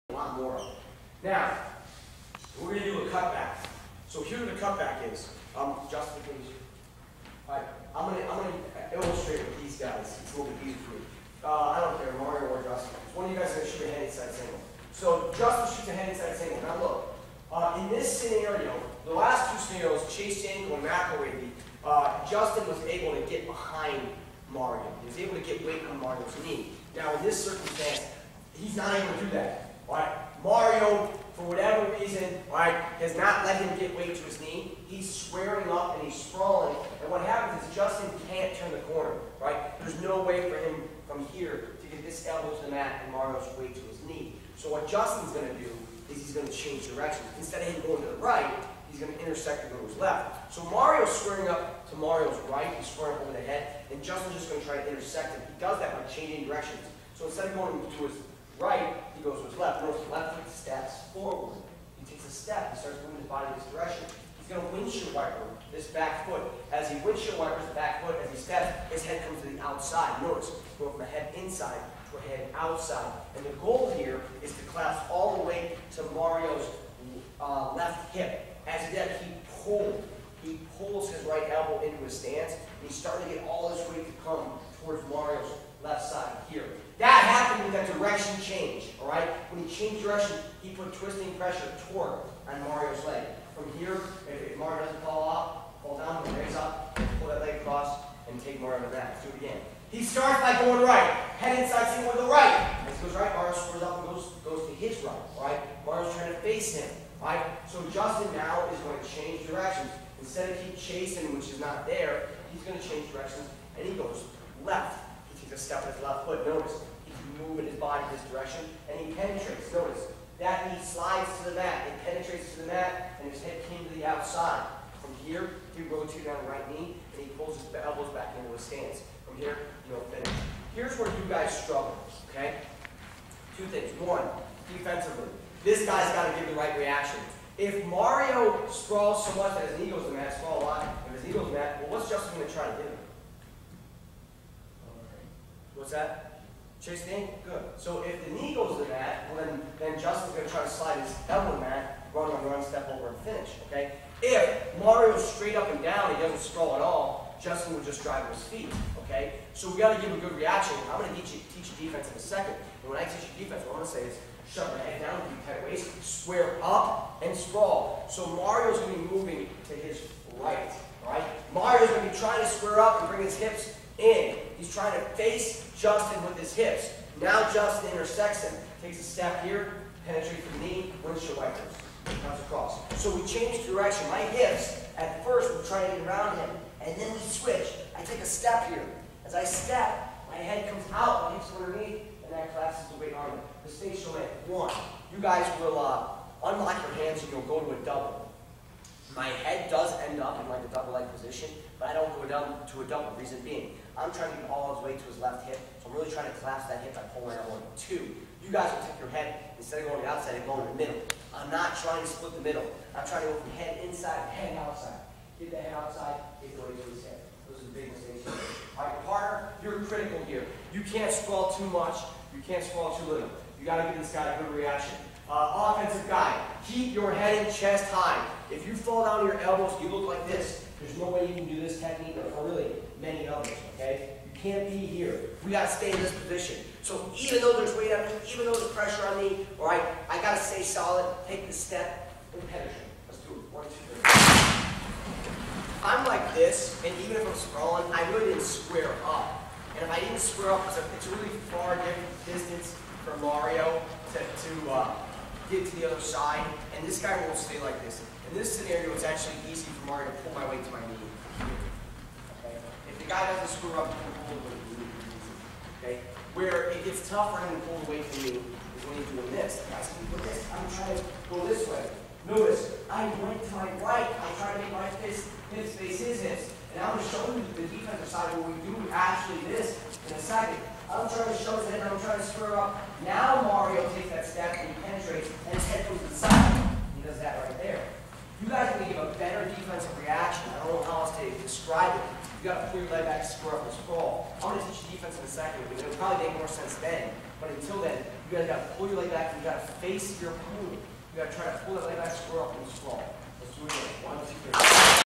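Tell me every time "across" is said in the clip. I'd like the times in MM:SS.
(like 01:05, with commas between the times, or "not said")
01:37, 03:02.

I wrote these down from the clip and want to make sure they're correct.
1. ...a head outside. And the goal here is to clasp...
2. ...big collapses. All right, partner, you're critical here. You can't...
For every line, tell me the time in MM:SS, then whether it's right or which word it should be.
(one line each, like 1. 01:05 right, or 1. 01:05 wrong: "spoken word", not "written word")
1. 01:12 right
2. 03:37 wrong: "mistakes", not "collapses".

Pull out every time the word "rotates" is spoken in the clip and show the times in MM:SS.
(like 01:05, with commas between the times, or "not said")
02:05.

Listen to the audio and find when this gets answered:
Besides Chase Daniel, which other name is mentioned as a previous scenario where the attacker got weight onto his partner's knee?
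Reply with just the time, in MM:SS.
00:20.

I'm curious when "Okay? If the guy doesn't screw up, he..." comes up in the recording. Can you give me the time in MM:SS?
04:22.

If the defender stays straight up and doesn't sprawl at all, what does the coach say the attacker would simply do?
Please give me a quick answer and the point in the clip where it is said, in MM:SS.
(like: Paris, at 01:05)
drive with his feet, at 02:38.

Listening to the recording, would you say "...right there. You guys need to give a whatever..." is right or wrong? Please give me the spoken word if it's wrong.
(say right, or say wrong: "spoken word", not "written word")
wrong: "better", not "whatever".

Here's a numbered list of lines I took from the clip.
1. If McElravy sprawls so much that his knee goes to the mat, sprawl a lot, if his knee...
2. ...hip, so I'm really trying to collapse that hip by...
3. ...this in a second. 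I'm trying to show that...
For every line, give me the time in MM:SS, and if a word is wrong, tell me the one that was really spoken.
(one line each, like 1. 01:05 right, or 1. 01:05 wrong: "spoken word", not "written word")
1. 02:17 wrong: "Mario", not "McElravy"
2. 03:25 right
3. 04:39 right.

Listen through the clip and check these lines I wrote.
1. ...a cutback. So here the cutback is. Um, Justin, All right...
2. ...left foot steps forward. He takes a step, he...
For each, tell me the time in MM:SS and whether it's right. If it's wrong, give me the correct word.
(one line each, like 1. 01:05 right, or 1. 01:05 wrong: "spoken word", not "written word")
1. 00:03 right
2. 01:00 right.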